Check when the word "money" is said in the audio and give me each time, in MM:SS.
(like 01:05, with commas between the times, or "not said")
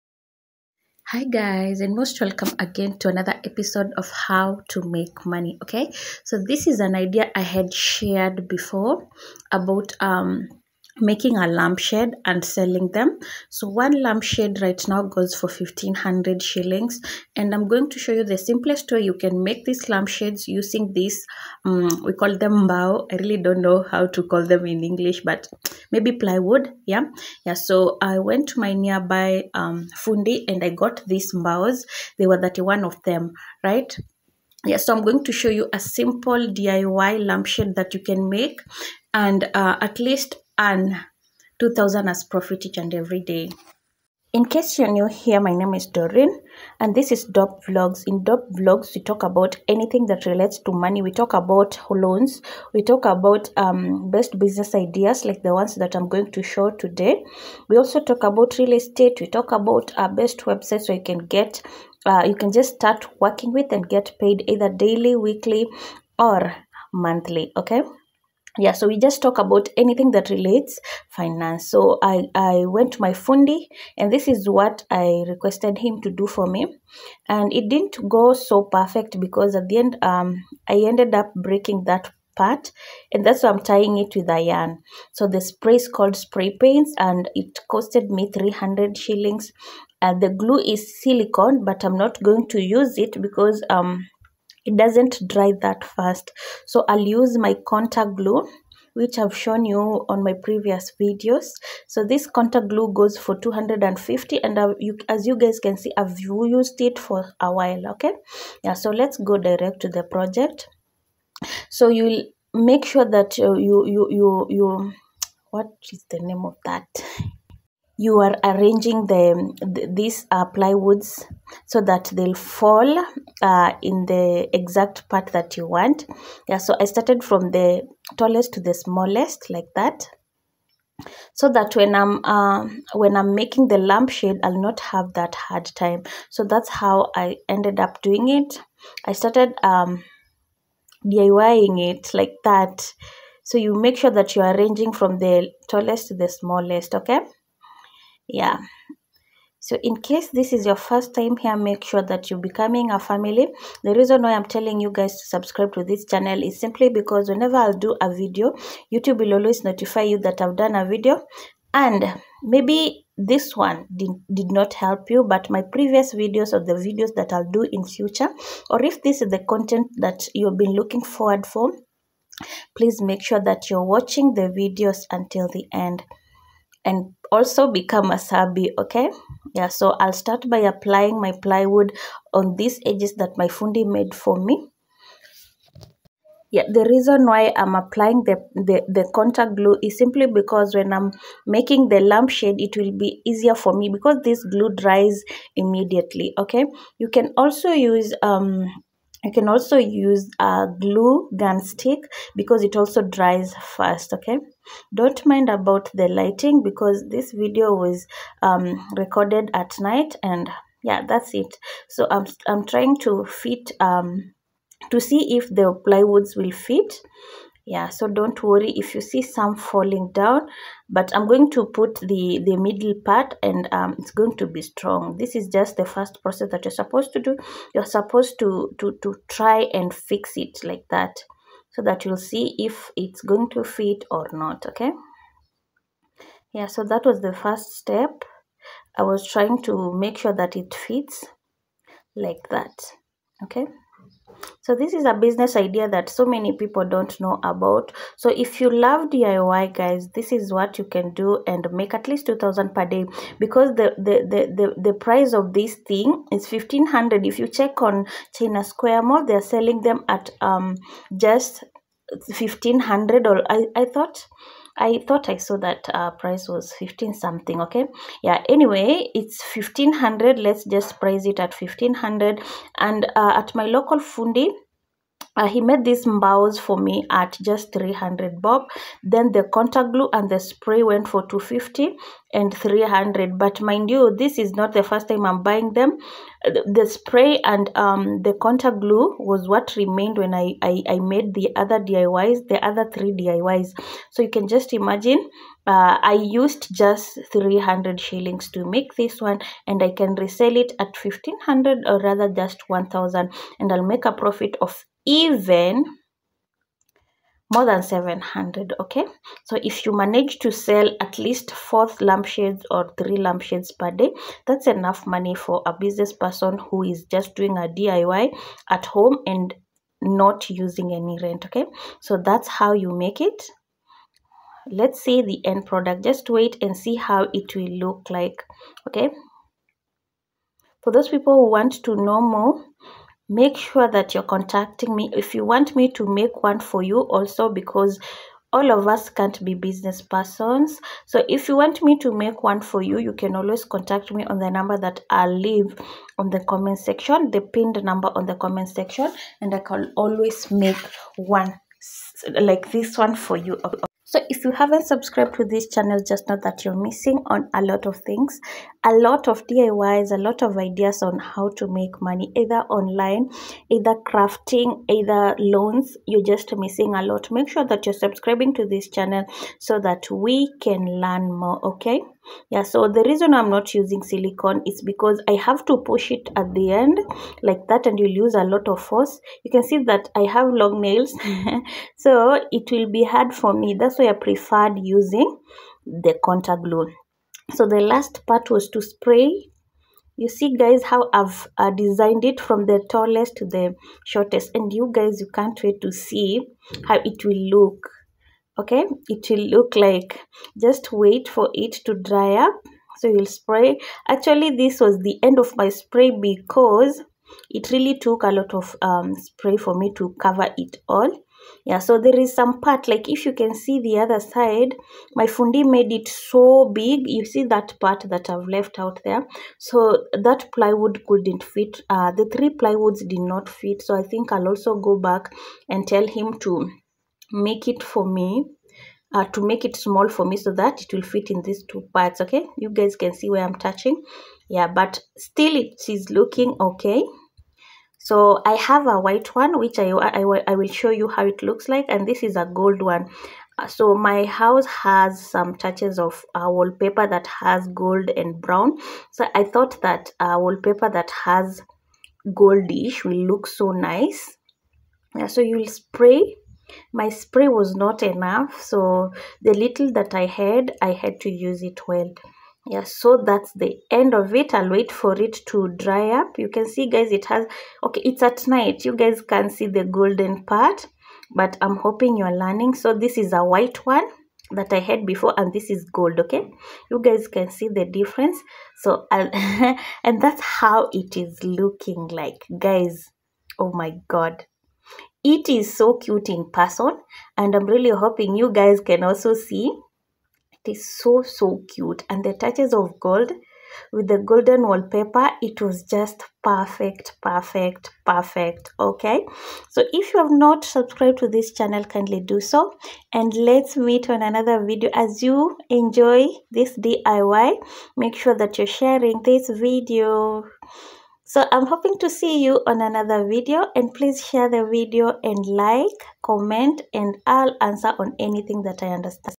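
00:05, 00:50, 05:15, 06:02.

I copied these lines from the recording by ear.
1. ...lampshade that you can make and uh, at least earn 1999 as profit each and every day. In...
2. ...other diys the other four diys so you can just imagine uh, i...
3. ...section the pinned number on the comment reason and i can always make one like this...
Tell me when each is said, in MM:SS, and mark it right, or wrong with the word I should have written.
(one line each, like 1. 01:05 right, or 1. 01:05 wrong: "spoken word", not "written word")
1. 00:37 wrong: "2000", not "1999"
2. 04:51 wrong: "three", not "four"
3. 05:46 wrong: "section", not "reason".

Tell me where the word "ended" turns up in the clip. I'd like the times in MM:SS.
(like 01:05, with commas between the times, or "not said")
01:20, 02:17.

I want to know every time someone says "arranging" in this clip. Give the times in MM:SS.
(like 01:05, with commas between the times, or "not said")
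01:58, 02:24.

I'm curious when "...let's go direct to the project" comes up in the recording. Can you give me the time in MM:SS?
01:48.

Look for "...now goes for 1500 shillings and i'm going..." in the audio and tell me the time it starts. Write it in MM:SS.
00:14.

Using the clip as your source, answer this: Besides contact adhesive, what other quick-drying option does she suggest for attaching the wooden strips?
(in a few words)
Glue gun stick.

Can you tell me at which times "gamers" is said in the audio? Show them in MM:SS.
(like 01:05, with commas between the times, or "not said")
not said.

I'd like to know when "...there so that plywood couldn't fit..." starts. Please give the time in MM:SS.
06:59.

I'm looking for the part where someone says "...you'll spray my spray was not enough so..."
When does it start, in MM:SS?
07:35.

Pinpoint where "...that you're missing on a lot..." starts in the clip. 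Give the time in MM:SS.
05:56.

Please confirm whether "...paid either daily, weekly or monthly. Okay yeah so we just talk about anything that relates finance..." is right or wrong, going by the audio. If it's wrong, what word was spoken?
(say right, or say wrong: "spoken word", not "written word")
right.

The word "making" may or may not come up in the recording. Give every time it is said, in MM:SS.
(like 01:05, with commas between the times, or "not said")
00:10, 02:13, 03:11.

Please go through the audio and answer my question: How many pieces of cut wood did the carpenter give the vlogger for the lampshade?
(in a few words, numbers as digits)
31.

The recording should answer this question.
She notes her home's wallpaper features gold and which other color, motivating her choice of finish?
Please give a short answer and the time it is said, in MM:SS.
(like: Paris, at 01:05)
Brown, at 07:28.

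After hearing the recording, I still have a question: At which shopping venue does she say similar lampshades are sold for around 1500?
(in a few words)
China Square Mall.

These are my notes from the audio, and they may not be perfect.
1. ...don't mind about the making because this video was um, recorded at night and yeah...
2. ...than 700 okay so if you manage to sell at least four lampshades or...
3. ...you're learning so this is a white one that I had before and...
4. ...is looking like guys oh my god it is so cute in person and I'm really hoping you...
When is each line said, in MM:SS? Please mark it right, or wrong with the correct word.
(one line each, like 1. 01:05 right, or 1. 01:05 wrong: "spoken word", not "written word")
1. 03:24 wrong: "lighting", not "making"
2. 05:07 right
3. 07:52 right
4. 08:01 right.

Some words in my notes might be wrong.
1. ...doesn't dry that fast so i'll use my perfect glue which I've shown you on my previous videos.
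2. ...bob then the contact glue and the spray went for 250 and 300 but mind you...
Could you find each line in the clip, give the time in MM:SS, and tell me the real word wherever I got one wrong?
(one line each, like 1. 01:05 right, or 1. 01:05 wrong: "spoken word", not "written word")
1. 01:34 wrong: "contact", not "perfect"
2. 04:38 right.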